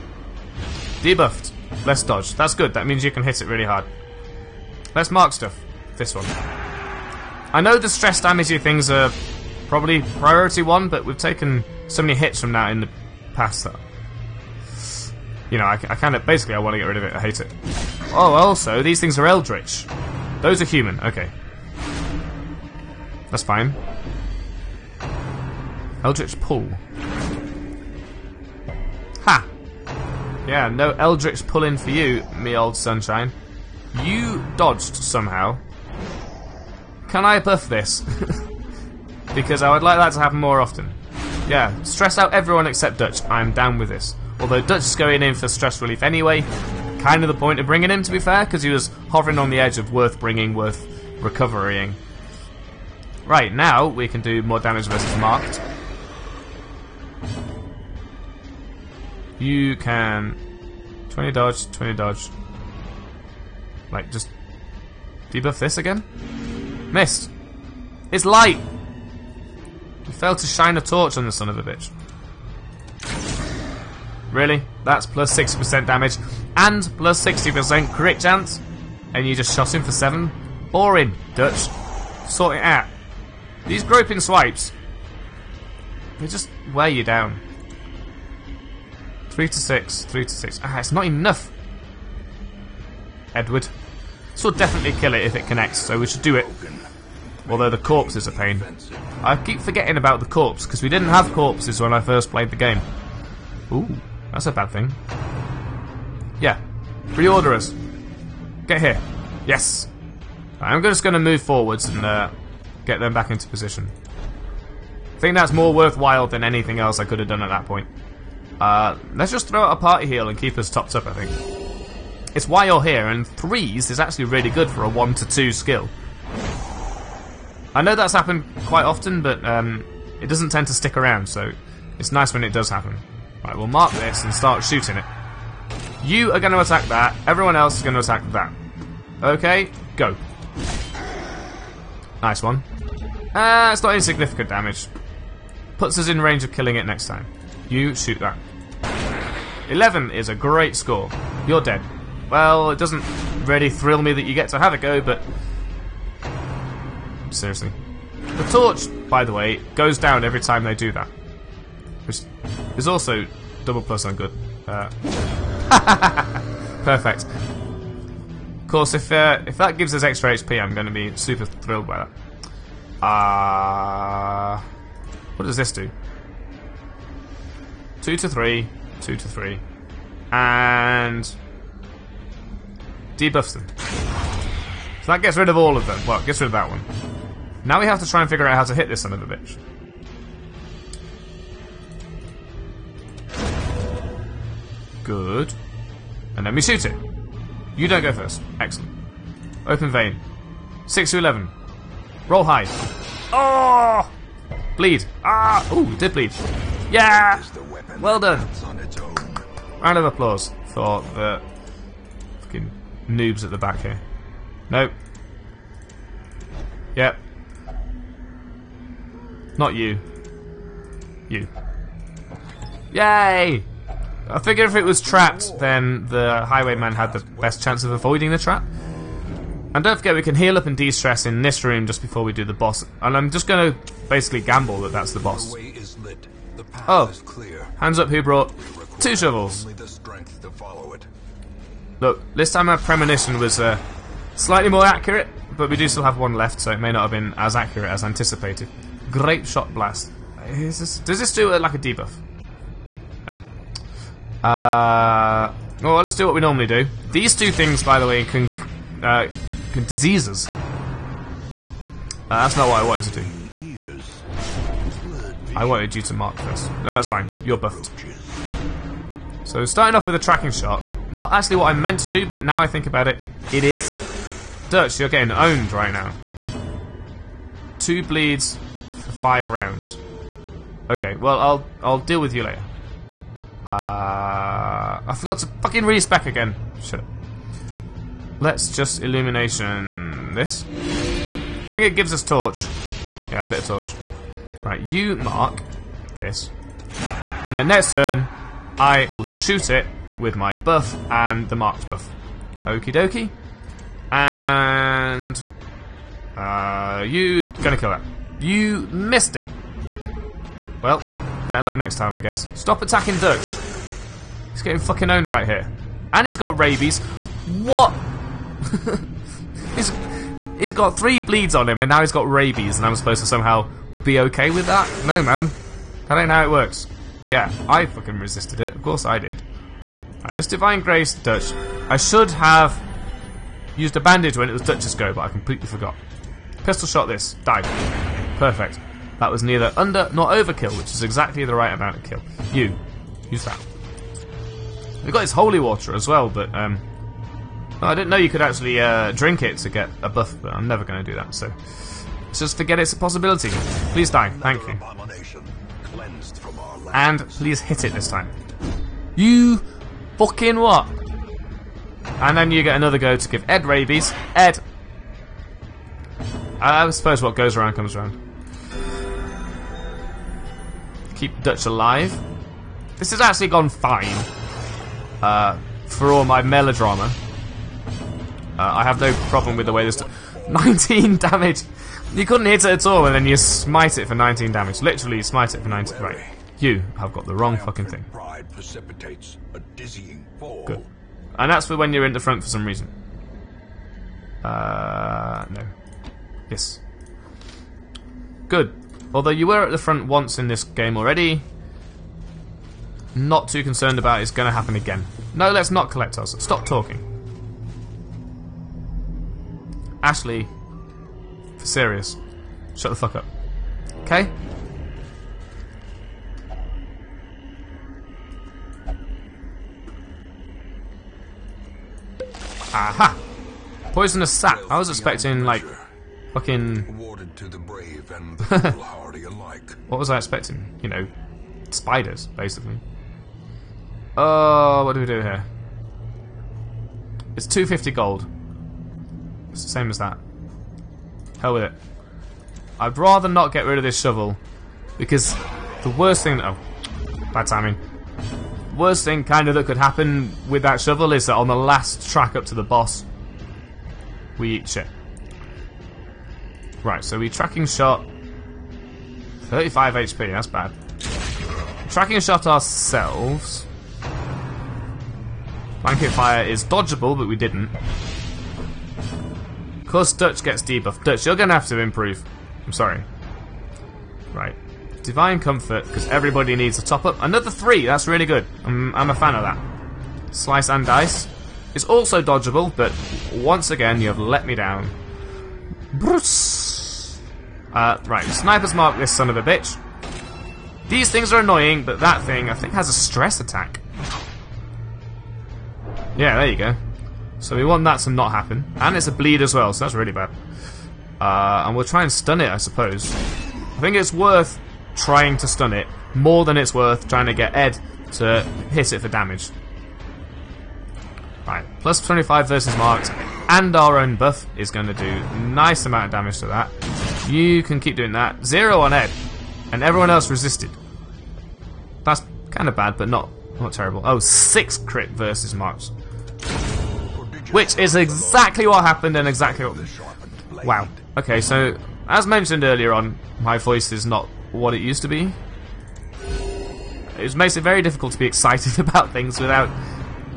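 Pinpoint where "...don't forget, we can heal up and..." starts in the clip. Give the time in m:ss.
3:49.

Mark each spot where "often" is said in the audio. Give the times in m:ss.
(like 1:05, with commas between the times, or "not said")
0:40, 2:08.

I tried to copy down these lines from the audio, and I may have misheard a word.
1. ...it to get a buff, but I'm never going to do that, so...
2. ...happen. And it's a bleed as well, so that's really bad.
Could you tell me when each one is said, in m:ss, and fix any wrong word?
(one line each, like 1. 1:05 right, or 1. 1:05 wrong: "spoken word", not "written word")
1. 5:49 right
2. 8:18 right.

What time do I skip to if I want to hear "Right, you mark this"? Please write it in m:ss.
4:54.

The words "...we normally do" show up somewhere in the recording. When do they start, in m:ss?
4:16.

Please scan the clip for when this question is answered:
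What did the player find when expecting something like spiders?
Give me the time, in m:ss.
7:03.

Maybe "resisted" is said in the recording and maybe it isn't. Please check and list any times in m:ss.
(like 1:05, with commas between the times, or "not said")
5:28, 8:40.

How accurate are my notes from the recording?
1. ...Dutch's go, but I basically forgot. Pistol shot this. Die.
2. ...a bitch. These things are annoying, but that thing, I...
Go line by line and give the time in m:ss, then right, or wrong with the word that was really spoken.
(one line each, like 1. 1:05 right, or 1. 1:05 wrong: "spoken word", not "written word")
1. 5:34 wrong: "completely", not "basically"
2. 8:09 right.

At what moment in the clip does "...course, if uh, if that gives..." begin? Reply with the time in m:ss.
2:48.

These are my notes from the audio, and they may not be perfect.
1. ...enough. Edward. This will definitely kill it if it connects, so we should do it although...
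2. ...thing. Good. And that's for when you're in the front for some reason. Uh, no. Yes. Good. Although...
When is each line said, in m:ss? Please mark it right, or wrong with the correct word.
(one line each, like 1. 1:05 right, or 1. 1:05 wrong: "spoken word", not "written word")
1. 1:31 right
2. 6:27 right.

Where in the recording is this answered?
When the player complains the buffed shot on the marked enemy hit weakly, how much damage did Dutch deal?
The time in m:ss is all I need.
1:19.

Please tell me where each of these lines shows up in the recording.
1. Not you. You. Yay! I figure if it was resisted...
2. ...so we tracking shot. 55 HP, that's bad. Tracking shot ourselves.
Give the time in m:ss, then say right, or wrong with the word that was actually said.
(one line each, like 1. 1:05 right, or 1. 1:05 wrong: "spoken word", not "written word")
1. 3:39 wrong: "trapped", not "resisted"
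2. 7:37 wrong: "35", not "55".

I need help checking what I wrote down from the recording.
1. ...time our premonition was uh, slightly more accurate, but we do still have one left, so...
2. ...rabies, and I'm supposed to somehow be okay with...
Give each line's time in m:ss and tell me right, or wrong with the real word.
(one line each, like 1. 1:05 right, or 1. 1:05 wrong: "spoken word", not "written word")
1. 4:02 right
2. 5:22 right.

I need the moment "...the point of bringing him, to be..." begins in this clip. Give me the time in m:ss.
0:47.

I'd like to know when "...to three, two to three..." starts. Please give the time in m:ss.
2:58.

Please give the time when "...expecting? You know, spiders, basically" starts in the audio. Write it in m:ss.
7:10.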